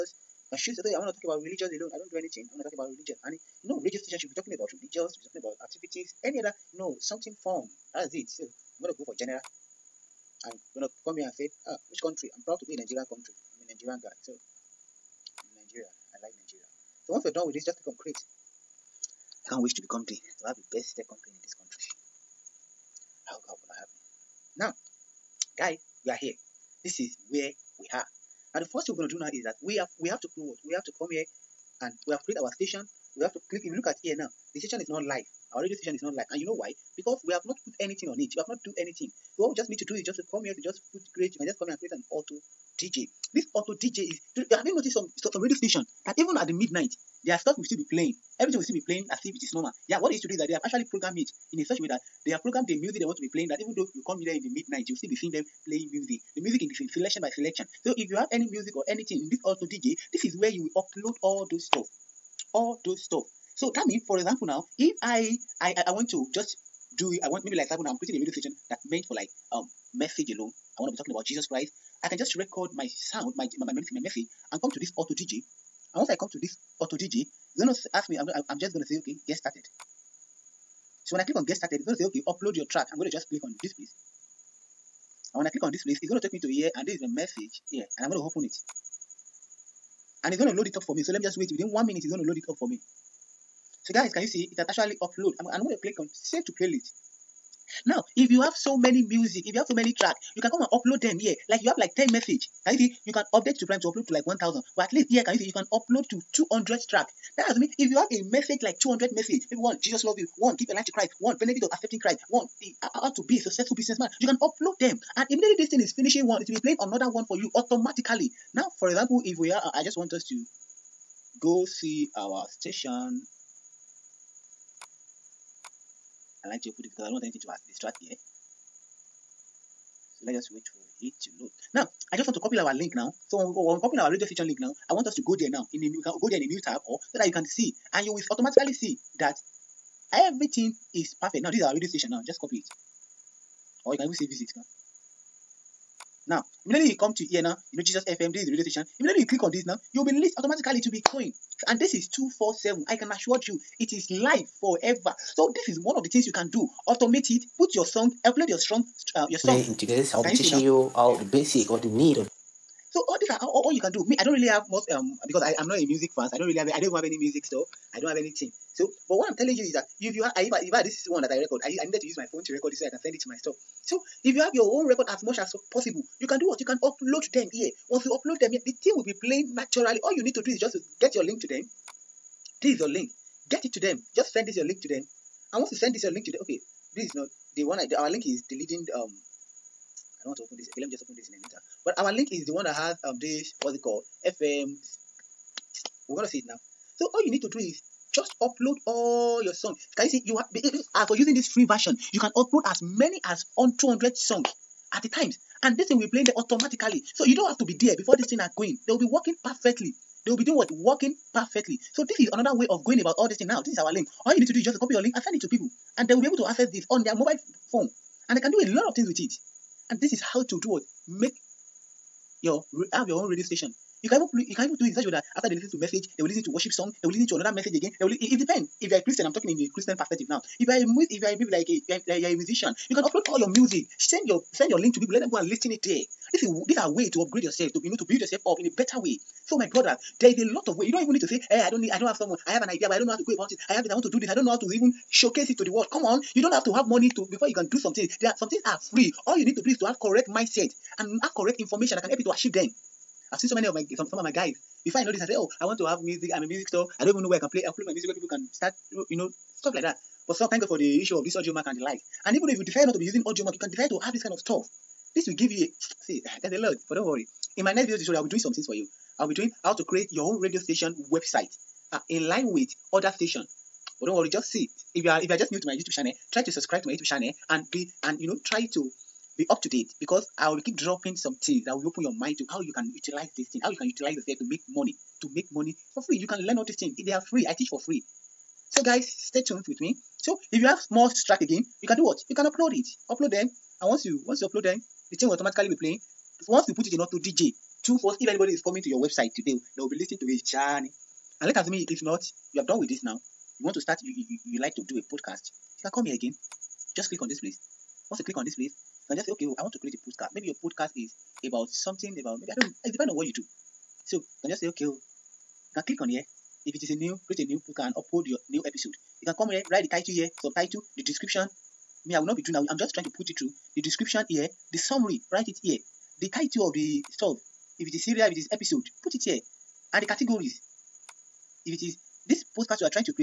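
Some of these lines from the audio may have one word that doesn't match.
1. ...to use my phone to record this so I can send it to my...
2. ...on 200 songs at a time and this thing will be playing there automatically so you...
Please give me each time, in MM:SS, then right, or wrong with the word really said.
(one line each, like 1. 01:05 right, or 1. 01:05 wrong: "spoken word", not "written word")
1. 02:52 right
2. 03:23 right.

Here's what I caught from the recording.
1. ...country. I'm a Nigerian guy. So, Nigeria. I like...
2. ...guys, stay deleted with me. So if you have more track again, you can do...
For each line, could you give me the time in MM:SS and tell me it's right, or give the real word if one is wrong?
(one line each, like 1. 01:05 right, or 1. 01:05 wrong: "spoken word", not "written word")
1. 00:13 right
2. 04:48 wrong: "tuned", not "deleted".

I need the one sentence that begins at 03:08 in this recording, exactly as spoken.
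um don't want to open this.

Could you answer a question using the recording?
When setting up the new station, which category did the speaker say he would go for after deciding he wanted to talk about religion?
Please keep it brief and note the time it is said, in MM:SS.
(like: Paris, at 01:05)
General, at 00:09.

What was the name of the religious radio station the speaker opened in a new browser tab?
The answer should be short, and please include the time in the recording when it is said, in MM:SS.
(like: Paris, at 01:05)
Jesus FM, at 02:27.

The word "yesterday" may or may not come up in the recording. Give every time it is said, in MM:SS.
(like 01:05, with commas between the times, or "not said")
not said.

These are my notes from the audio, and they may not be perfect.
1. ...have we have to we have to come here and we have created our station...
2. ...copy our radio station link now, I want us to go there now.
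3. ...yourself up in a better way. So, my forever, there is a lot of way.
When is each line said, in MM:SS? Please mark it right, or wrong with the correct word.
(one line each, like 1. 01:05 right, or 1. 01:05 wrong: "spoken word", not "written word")
1. 00:29 right
2. 02:13 right
3. 03:58 wrong: "brother", not "forever".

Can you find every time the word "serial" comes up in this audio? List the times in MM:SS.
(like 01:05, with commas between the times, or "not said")
05:28.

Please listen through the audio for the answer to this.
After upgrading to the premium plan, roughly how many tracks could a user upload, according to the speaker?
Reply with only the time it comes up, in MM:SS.
01:44.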